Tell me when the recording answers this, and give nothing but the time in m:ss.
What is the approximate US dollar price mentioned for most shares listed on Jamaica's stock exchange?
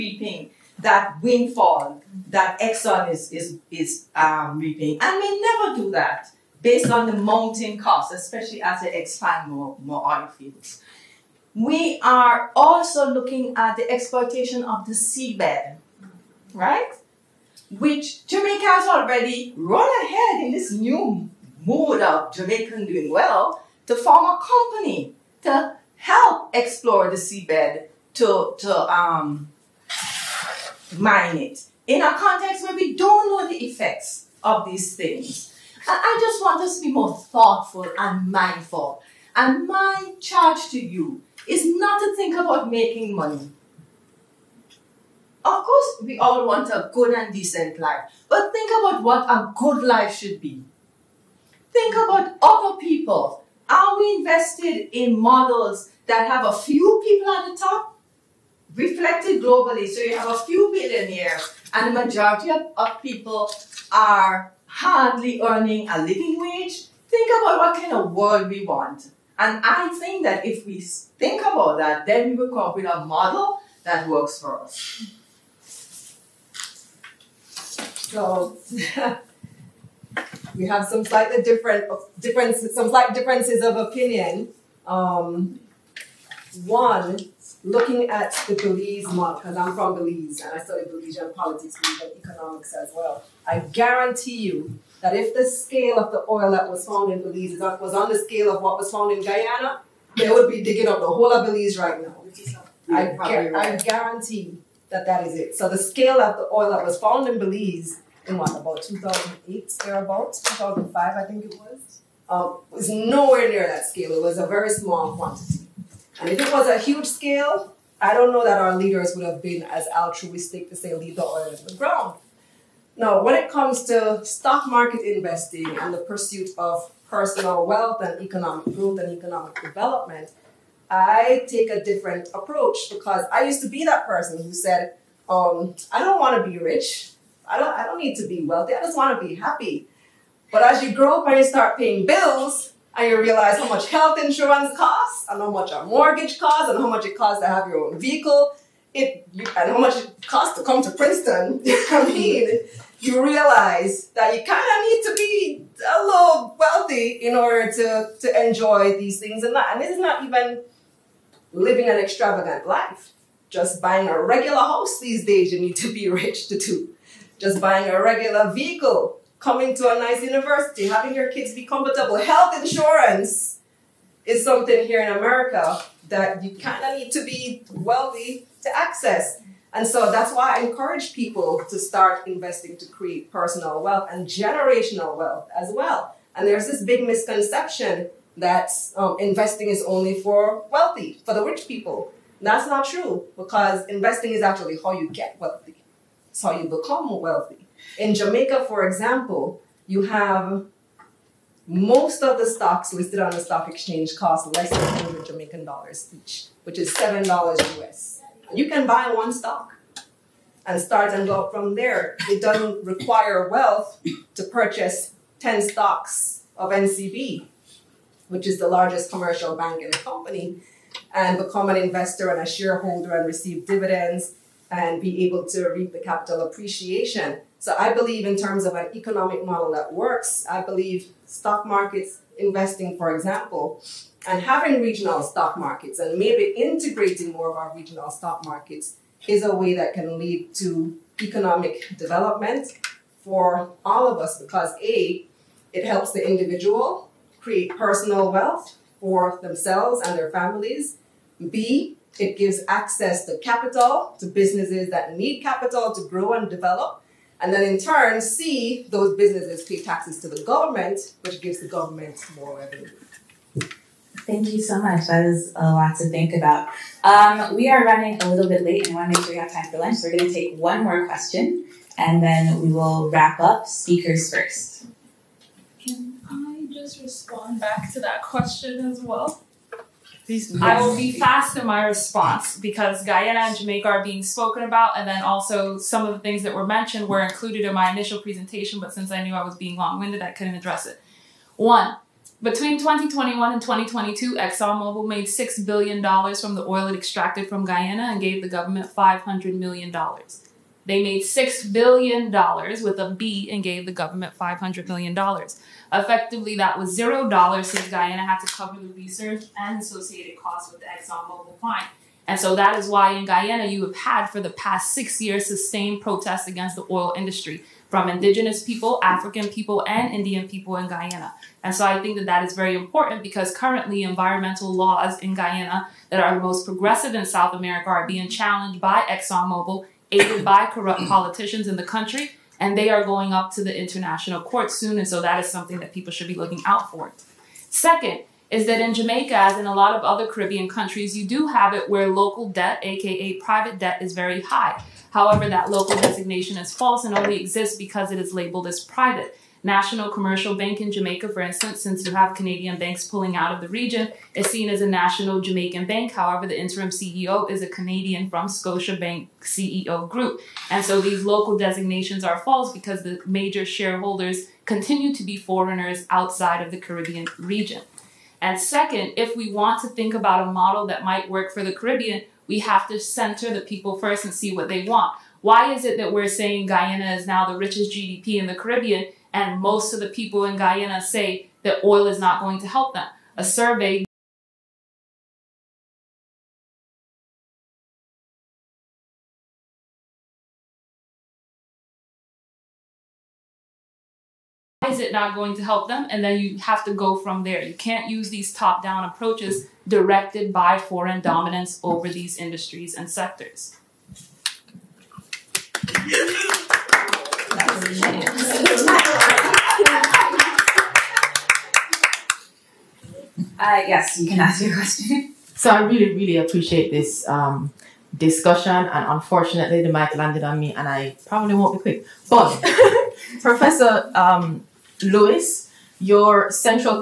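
3:26.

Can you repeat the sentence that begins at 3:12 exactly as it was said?
that's not true because investing is actually how you get wealthy.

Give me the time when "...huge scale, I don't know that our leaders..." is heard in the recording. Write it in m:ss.
1:56.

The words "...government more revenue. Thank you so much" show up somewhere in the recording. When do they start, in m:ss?
4:21.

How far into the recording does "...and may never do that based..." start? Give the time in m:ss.
0:05.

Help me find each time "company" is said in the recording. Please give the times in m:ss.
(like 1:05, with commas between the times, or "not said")
0:24, 3:39.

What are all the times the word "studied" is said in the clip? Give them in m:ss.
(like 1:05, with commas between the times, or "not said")
1:30.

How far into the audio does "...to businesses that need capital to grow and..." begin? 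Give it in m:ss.
4:14.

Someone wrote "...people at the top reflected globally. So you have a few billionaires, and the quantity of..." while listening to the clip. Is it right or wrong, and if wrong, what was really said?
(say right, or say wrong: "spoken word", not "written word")
wrong: "majority", not "quantity".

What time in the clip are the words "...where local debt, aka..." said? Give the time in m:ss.
5:41.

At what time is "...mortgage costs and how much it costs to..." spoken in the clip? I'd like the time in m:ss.
2:25.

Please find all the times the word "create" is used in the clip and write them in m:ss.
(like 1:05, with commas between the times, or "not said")
3:02, 4:07.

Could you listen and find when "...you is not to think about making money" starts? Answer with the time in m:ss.
0:40.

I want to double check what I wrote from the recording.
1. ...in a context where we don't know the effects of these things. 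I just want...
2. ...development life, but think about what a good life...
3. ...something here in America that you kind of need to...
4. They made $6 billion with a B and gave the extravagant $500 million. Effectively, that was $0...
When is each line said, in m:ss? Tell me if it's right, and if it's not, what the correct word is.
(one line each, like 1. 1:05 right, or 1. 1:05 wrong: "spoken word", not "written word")
1. 0:31 right
2. 0:47 wrong: "decent", not "development"
3. 2:54 right
4. 5:00 wrong: "government", not "extravagant".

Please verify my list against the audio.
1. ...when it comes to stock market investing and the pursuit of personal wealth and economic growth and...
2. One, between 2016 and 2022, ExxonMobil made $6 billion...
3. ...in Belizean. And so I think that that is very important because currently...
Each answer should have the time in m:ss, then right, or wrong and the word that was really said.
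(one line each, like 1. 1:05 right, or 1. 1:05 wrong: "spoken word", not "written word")
1. 2:03 right
2. 4:51 wrong: "2021", not "2016"
3. 5:20 wrong: "Guyana", not "Belizean".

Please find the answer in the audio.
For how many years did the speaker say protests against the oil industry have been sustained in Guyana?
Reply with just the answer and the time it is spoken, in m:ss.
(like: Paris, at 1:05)
6, at 5:14.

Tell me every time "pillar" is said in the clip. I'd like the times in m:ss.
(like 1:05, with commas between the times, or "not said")
not said.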